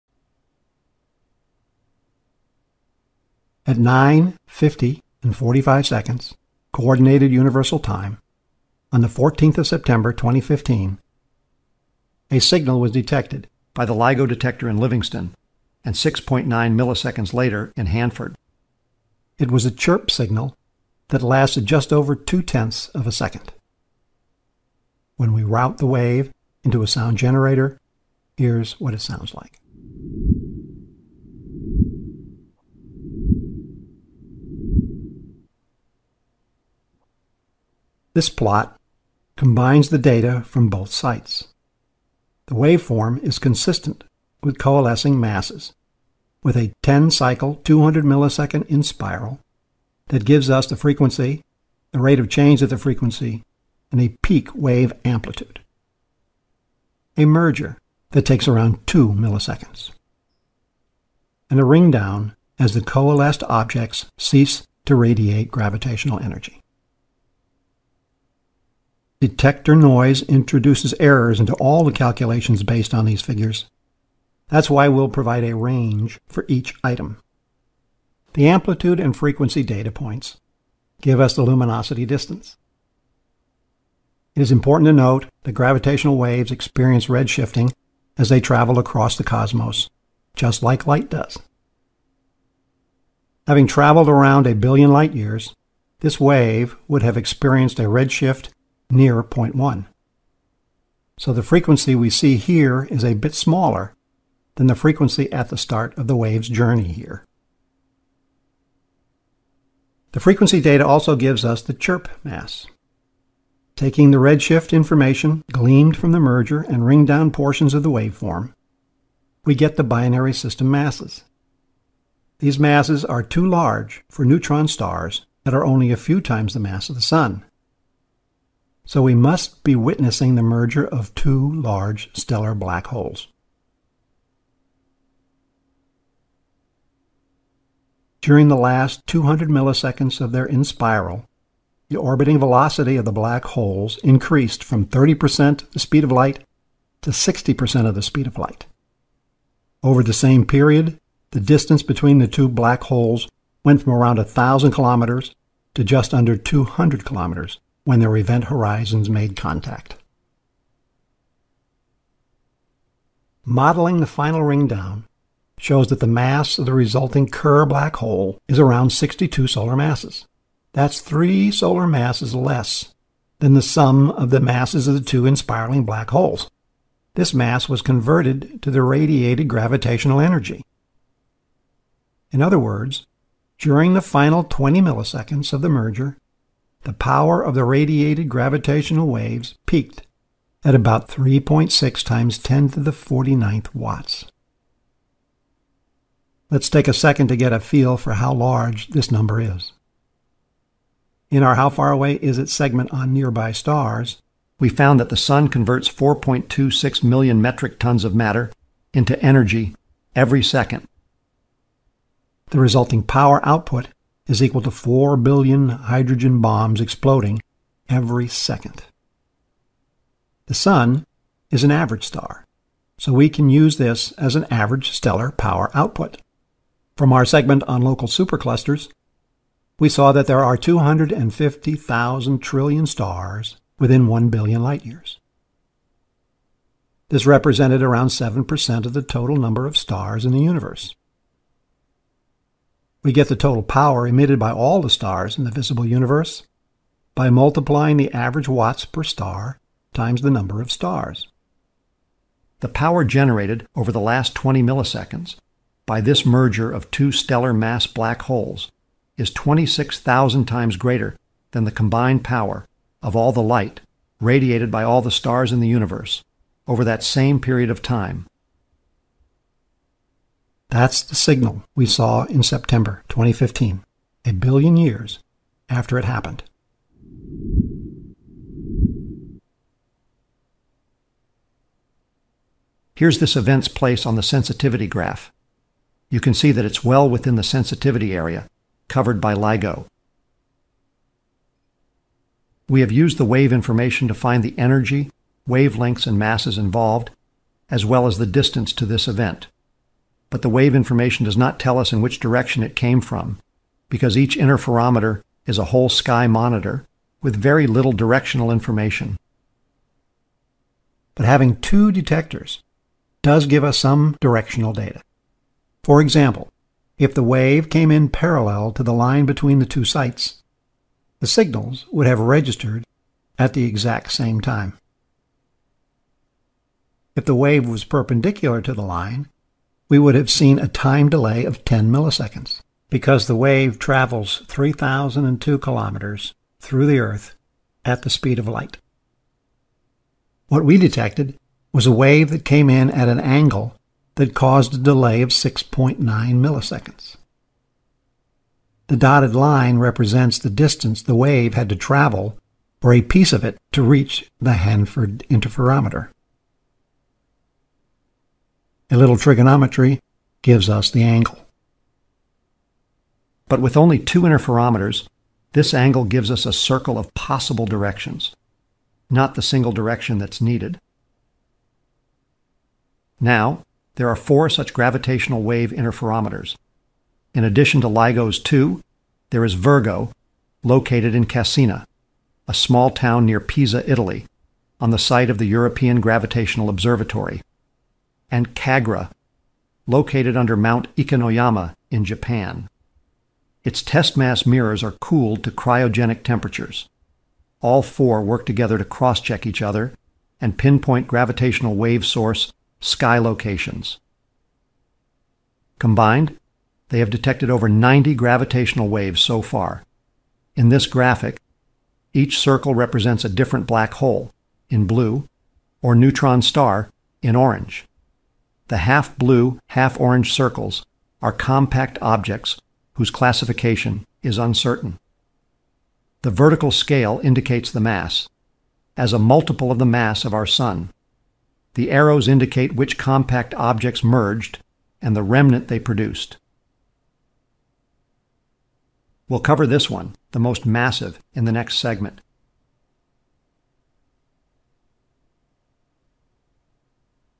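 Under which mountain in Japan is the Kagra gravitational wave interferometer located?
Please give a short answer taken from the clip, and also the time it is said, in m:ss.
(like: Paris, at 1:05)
Mount Ikenoyama, at 6:30.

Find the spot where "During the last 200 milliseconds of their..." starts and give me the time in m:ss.
2:18.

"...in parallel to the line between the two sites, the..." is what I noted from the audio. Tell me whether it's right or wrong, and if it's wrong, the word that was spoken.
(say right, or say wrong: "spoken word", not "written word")
right.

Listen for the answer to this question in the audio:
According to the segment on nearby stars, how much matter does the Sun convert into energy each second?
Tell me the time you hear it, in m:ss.
3:25.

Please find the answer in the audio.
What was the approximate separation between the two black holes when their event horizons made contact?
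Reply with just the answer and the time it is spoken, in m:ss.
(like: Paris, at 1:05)
just under 200 kilometers, at 2:35.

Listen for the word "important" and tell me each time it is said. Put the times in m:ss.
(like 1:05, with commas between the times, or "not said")
1:24.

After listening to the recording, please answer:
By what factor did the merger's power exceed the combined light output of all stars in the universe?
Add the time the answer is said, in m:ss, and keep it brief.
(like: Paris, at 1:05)
26,000, at 4:19.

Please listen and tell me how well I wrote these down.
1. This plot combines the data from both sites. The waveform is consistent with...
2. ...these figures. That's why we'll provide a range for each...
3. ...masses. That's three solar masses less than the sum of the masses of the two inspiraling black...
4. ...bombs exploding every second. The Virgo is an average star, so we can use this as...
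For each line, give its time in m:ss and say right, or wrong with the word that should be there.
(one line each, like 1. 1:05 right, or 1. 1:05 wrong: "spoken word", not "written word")
1. 0:38 right
2. 1:13 right
3. 2:49 right
4. 3:36 wrong: "Sun", not "Virgo".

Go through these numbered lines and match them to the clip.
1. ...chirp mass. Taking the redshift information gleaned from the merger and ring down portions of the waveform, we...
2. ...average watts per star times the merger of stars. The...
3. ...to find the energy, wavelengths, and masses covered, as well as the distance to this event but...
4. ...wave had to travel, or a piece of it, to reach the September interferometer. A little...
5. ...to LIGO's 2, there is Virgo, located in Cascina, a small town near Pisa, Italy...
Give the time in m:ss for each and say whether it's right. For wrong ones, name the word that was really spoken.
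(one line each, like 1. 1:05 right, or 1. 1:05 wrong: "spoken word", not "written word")
1. 1:51 right
2. 4:08 wrong: "number", not "merger"
3. 4:54 wrong: "involved", not "covered"
4. 5:51 wrong: "Hanford", not "September"
5. 6:17 right.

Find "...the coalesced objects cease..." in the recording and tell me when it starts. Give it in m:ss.
1:02.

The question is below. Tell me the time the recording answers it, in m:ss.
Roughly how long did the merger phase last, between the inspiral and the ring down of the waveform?
0:58.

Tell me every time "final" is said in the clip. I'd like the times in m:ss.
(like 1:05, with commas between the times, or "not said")
2:44, 3:04.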